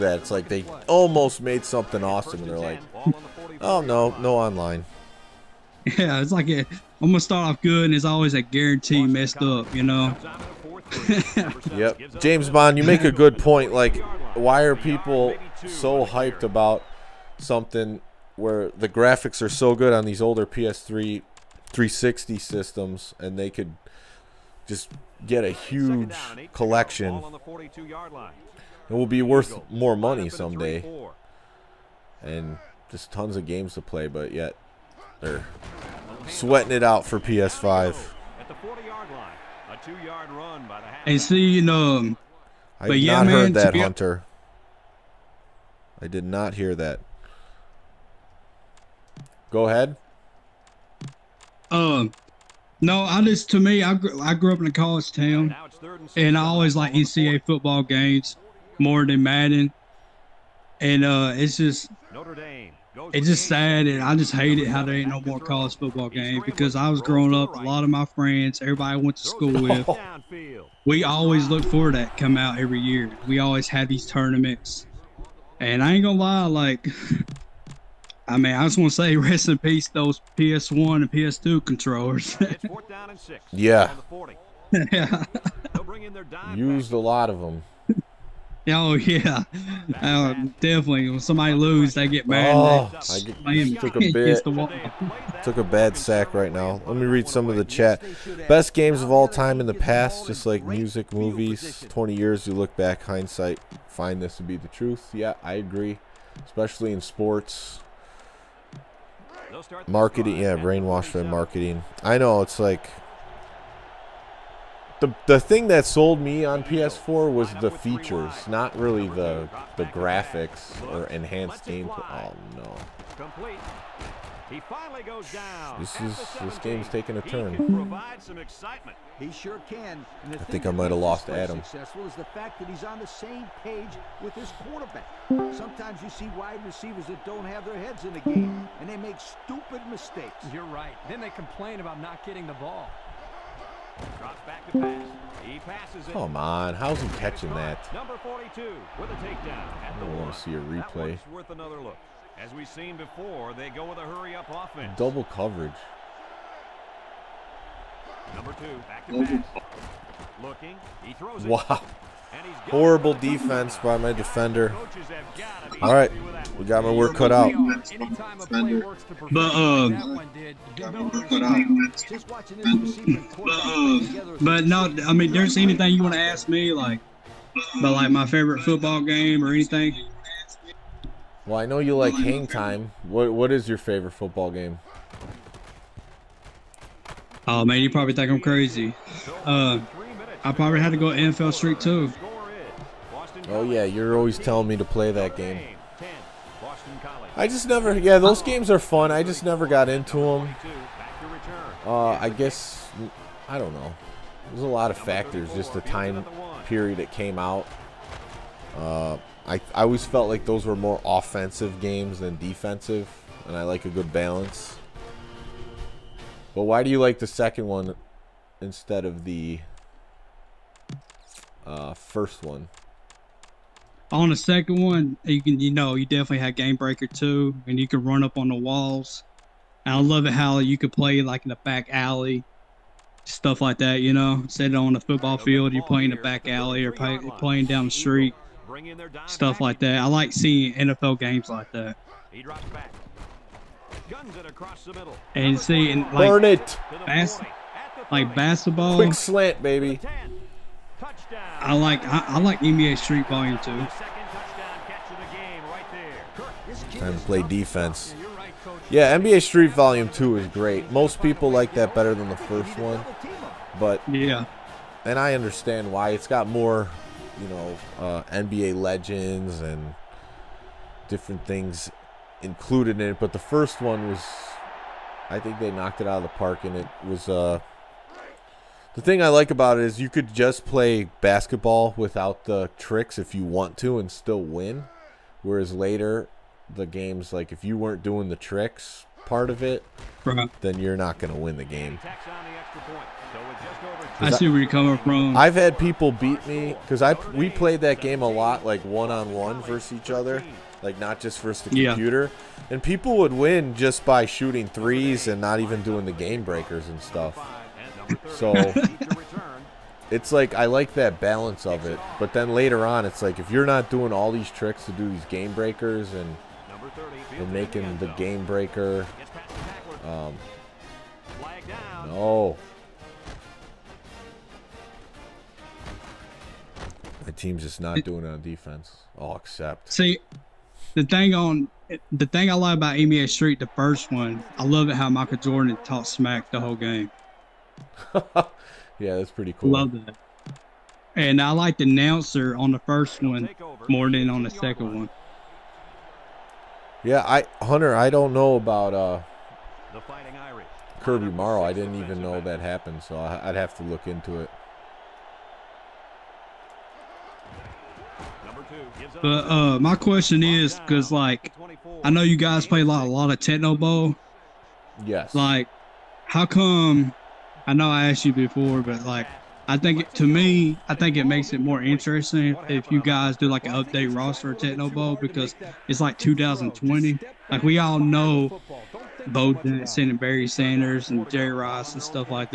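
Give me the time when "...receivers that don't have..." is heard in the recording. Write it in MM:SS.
02:16.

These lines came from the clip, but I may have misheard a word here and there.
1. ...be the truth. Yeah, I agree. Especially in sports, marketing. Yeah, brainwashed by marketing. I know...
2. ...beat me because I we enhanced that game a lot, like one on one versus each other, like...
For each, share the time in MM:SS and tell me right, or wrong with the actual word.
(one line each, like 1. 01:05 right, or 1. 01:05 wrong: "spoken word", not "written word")
1. 01:44 right
2. 04:56 wrong: "played", not "enhanced".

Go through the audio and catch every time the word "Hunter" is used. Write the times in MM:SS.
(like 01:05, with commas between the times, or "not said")
00:43, 05:47.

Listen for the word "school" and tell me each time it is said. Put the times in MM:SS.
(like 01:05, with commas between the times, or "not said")
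01:09.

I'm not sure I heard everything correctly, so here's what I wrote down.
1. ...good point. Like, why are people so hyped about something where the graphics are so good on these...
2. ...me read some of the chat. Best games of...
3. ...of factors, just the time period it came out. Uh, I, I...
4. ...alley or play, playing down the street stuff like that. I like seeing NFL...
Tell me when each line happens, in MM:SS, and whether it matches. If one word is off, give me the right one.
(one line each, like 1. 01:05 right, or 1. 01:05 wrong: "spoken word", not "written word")
1. 00:13 right
2. 01:36 right
3. 03:24 right
4. 03:56 right.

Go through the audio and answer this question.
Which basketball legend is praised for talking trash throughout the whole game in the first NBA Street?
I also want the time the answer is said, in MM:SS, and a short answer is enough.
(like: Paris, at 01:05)
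Michael Jordan, at 05:35.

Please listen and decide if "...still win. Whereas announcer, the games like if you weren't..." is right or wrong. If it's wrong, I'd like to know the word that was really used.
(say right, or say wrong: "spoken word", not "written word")
wrong: "later", not "announcer".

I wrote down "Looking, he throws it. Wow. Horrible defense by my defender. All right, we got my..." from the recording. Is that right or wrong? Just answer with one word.
right.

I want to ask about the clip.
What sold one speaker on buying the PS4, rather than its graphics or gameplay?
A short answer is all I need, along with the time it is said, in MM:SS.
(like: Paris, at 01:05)
The features, at 01:57.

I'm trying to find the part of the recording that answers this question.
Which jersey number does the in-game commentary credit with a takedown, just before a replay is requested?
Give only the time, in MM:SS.
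02:27.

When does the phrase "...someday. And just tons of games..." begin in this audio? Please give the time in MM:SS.
00:30.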